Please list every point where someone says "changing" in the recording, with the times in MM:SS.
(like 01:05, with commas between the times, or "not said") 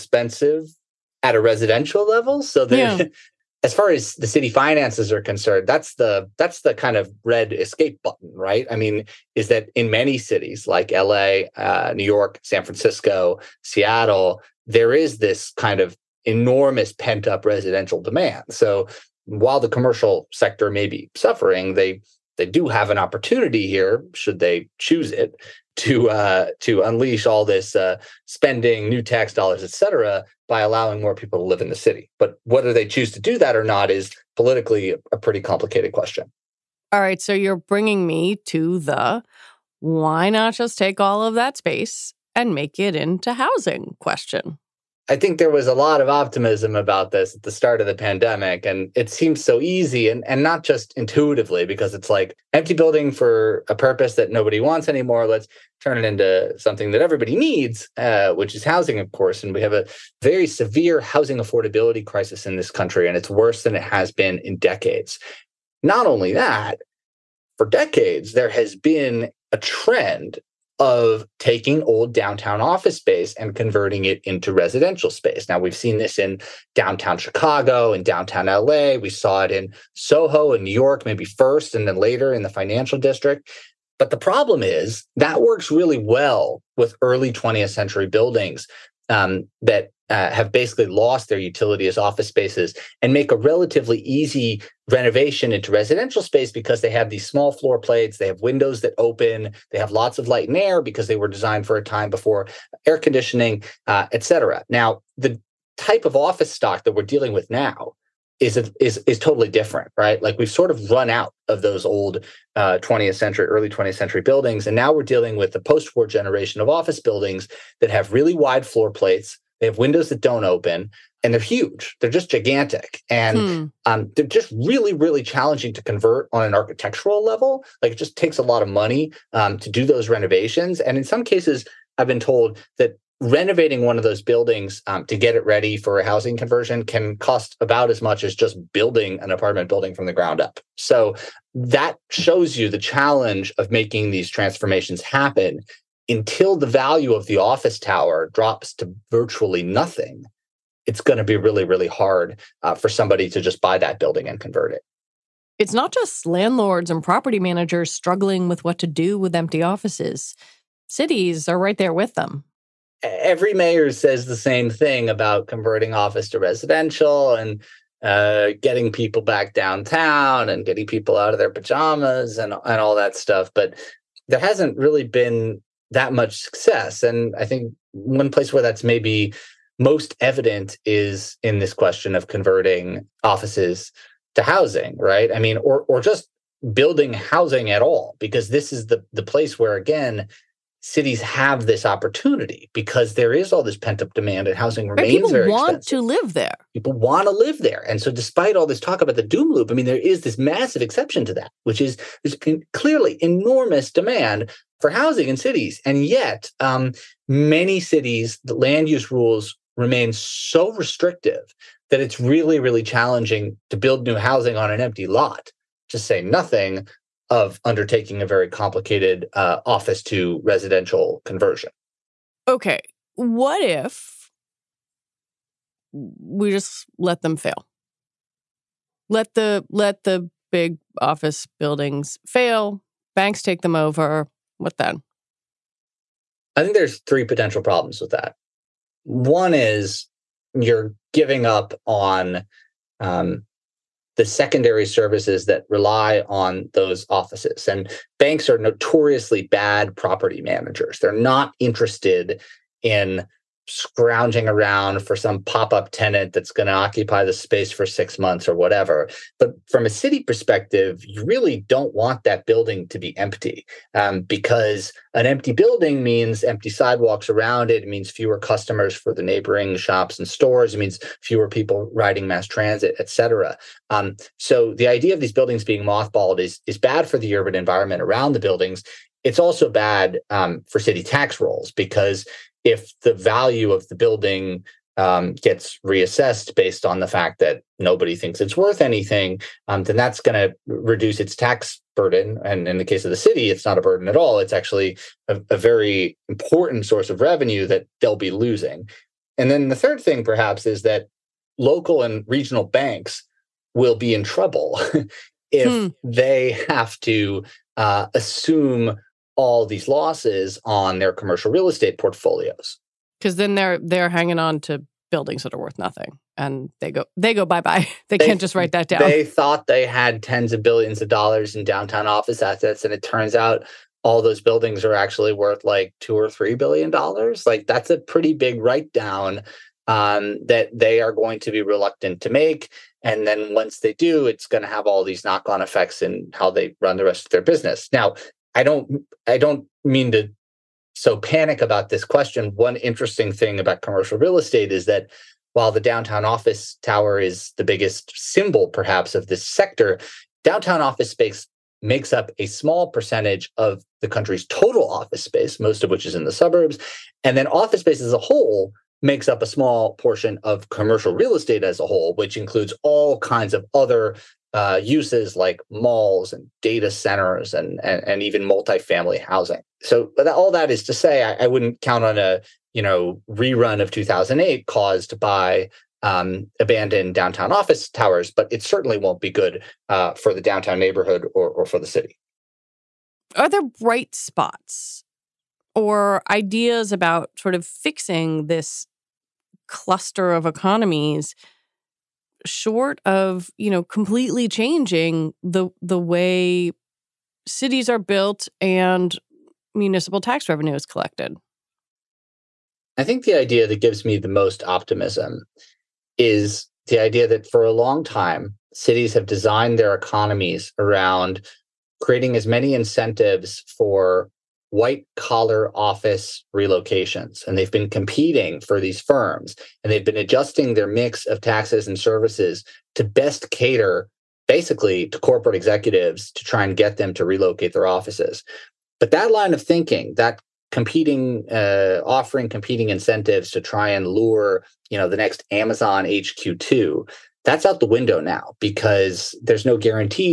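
06:34.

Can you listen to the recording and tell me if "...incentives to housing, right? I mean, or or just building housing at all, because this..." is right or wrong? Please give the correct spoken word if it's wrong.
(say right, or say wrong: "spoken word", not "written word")
wrong: "offices", not "incentives".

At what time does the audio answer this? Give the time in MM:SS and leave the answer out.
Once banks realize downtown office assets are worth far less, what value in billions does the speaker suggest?
05:26.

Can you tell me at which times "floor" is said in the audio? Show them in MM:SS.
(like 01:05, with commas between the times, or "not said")
01:37, 01:58.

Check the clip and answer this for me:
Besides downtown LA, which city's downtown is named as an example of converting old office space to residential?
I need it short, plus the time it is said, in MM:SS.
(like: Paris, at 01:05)
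Chicago, at 01:16.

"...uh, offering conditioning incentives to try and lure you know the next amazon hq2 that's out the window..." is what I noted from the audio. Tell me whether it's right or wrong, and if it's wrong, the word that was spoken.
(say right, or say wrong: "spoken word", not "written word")
wrong: "competing", not "conditioning".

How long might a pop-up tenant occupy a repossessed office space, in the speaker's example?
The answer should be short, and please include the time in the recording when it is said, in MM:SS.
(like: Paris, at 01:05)
6 months, at 04:17.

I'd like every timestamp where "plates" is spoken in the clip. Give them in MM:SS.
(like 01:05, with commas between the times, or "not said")
01:37, 01:58.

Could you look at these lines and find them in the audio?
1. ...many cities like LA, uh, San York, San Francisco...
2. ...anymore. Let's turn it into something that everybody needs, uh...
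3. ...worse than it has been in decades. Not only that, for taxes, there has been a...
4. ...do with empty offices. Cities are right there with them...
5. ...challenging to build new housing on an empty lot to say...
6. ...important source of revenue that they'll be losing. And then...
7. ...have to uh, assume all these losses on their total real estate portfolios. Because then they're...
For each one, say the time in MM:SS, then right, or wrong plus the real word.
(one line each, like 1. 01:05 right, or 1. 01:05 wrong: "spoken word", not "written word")
1. 00:09 wrong: "New", not "San"
2. 00:54 right
3. 01:03 wrong: "decades", not "taxes"
4. 02:38 right
5. 03:32 right
6. 04:56 right
7. 05:06 wrong: "commercial", not "total".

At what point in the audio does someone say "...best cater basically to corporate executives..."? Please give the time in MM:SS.
07:03.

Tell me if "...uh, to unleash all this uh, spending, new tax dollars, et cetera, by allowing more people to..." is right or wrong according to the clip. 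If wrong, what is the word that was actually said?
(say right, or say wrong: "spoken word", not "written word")
right.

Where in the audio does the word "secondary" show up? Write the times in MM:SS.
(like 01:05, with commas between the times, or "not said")
04:04.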